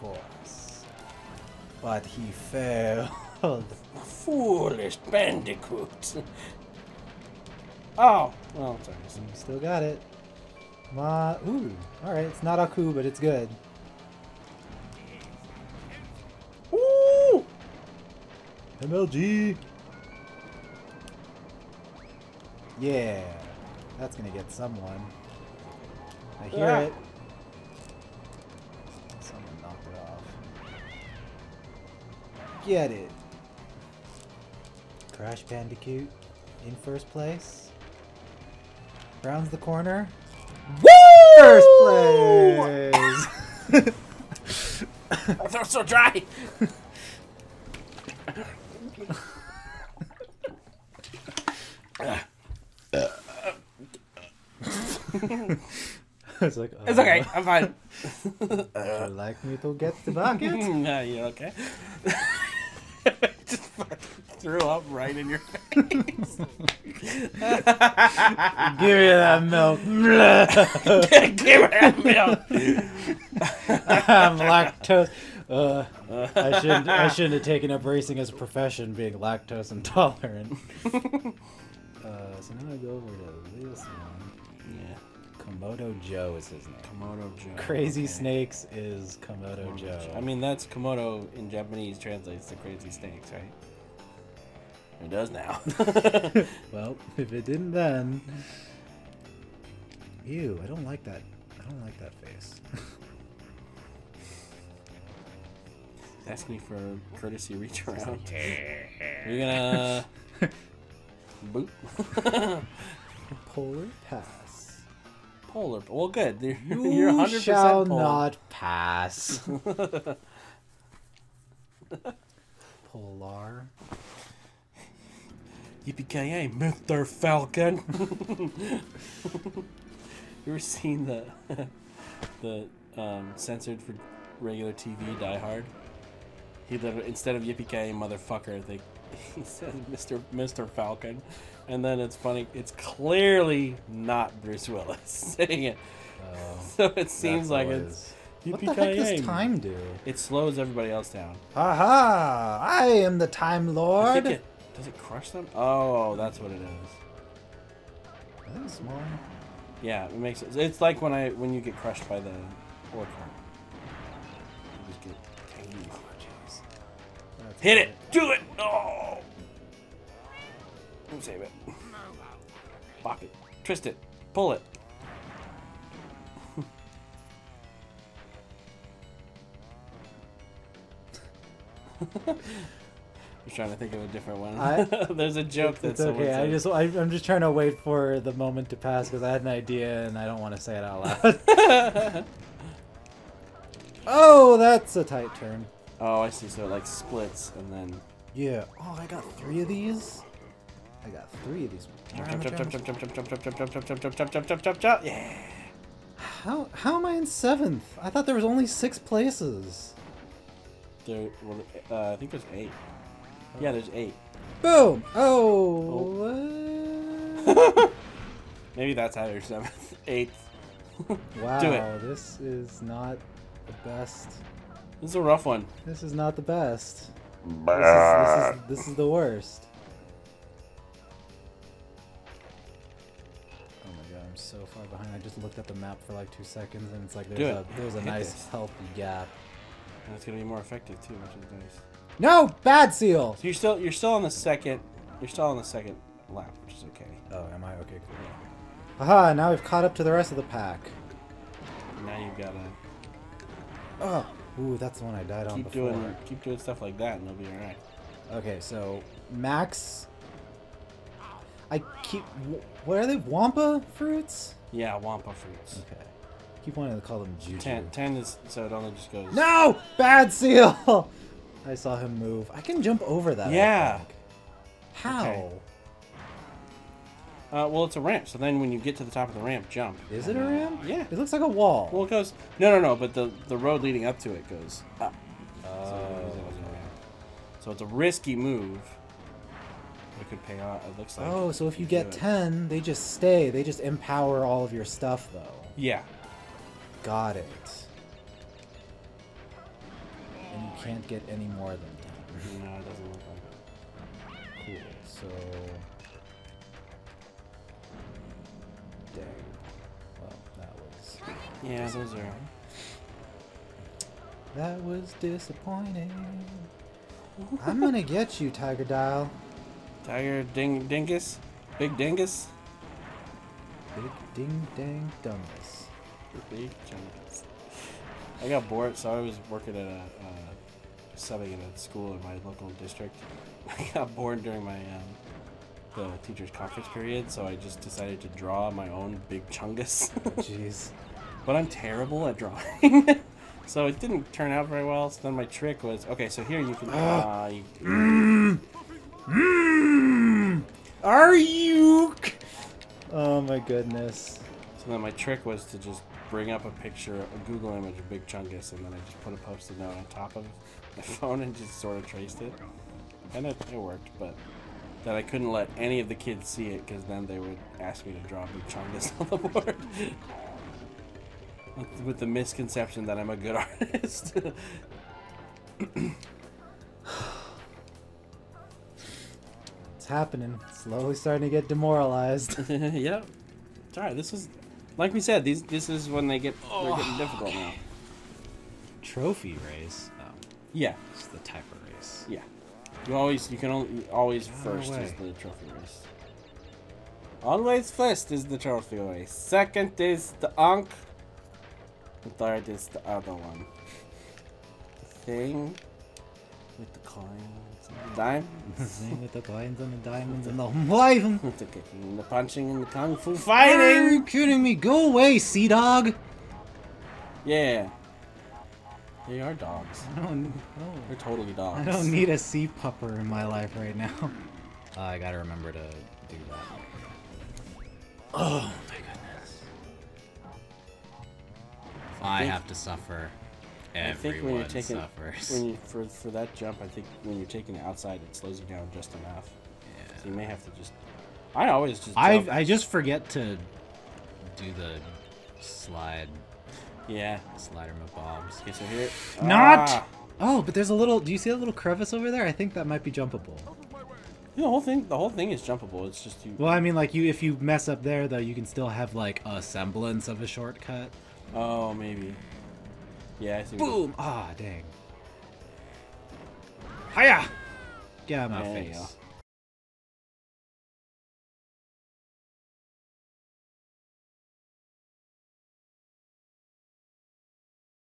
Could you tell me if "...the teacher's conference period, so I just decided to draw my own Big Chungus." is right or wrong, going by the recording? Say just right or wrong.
right.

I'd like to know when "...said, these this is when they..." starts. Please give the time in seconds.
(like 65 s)
385 s.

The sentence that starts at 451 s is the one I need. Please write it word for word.
Do you see that little crevice over there?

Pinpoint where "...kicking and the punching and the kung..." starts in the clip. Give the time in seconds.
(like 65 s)
411 s.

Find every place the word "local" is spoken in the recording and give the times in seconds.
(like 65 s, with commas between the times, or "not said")
332 s.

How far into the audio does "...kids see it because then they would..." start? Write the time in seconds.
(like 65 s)
366 s.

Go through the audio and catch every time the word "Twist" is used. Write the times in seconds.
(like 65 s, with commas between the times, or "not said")
173 s.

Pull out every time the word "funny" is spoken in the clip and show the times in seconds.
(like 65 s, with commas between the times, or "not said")
142 s.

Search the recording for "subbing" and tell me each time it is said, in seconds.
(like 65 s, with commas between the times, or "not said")
331 s.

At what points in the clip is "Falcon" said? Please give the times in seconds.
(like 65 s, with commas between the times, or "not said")
127 s, 140 s.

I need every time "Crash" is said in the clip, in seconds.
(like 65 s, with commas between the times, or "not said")
35 s.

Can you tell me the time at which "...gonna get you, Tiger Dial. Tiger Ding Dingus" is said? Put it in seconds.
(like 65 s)
317 s.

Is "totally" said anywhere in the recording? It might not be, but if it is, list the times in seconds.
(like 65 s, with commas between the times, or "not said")
421 s.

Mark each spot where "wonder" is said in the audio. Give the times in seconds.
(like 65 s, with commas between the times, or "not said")
not said.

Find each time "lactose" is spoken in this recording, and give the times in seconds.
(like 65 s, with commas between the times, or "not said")
74 s, 79 s.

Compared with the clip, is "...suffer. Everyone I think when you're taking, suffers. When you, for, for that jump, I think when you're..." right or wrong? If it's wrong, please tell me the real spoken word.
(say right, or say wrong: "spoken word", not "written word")
right.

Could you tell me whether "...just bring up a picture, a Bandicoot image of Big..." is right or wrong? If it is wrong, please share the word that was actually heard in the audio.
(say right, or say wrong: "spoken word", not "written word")
wrong: "Google", not "Bandicoot".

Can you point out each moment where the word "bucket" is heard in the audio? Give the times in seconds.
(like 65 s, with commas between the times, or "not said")
60 s.